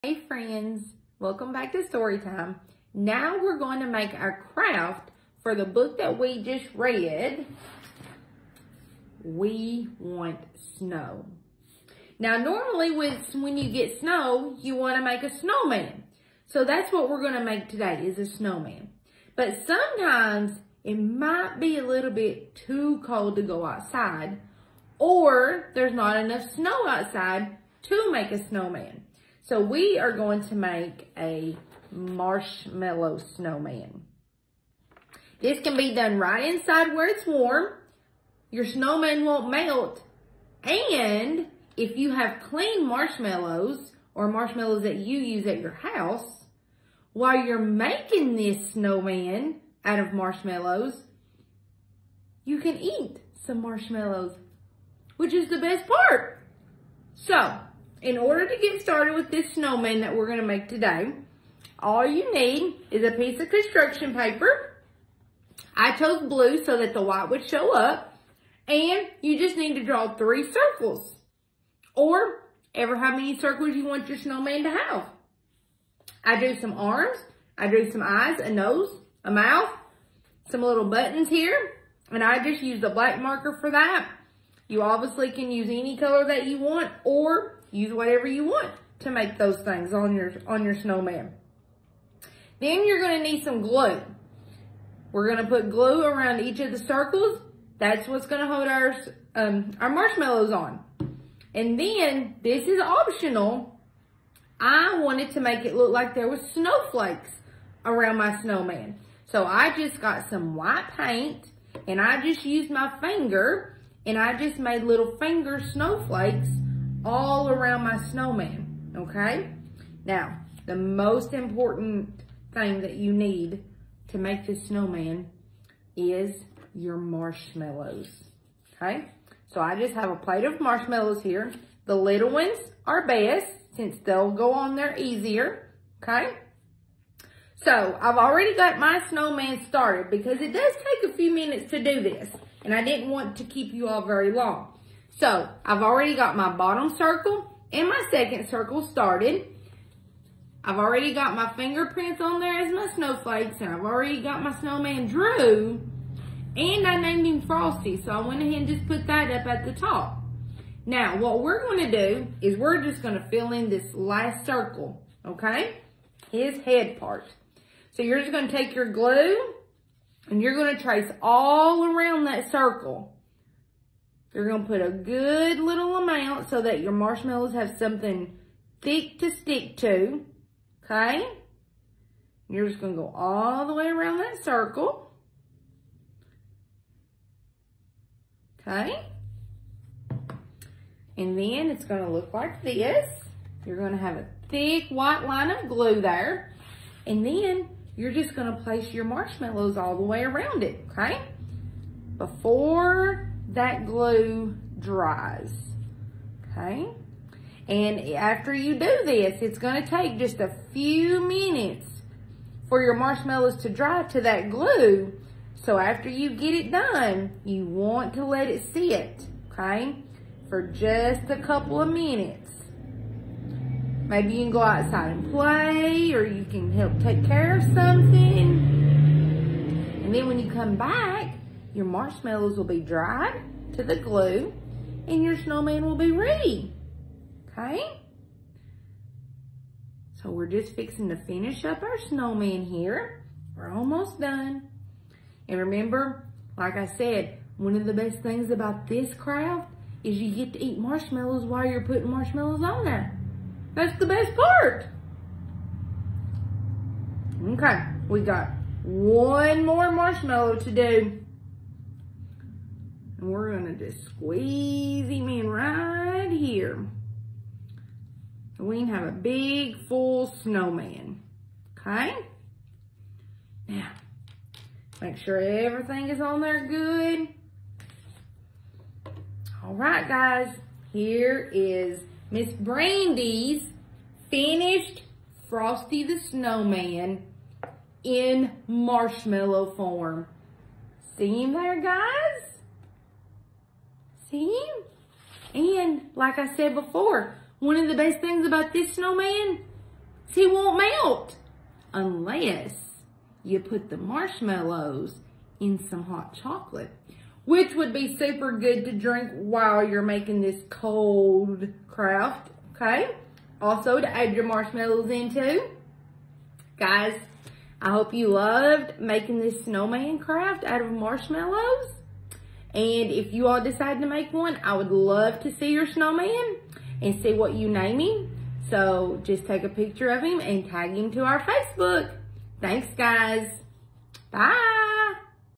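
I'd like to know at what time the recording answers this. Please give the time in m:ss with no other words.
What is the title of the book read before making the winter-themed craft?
0:09.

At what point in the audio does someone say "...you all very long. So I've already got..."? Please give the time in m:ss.
2:23.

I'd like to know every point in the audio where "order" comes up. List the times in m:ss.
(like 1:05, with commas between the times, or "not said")
0:58.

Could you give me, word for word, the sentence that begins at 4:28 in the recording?
So we can have a big, full snowman, okay?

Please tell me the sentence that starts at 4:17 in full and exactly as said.
Okay, we got one more marshmallow to do.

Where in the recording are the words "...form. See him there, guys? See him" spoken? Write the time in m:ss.
4:49.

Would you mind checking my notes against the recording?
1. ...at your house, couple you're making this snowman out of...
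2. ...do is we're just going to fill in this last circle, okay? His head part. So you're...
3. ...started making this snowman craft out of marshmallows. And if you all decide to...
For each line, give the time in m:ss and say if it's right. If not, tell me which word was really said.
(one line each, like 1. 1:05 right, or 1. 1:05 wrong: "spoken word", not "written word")
1. 0:45 wrong: "while", not "couple"
2. 2:41 right
3. 5:18 wrong: "loved", not "started".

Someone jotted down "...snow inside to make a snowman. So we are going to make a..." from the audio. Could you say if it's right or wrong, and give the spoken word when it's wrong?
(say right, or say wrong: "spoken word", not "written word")
wrong: "outside", not "inside".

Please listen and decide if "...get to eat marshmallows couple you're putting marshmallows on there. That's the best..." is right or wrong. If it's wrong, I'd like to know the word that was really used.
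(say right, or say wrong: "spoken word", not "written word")
wrong: "while", not "couple".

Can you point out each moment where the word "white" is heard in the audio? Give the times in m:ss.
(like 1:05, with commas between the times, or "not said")
1:07, 1:50, 3:14.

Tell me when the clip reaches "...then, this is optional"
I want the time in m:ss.
1:41.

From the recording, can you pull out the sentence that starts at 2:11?
The little ones are best since they'll go on there easier, okay?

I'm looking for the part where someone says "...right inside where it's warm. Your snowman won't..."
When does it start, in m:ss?
0:36.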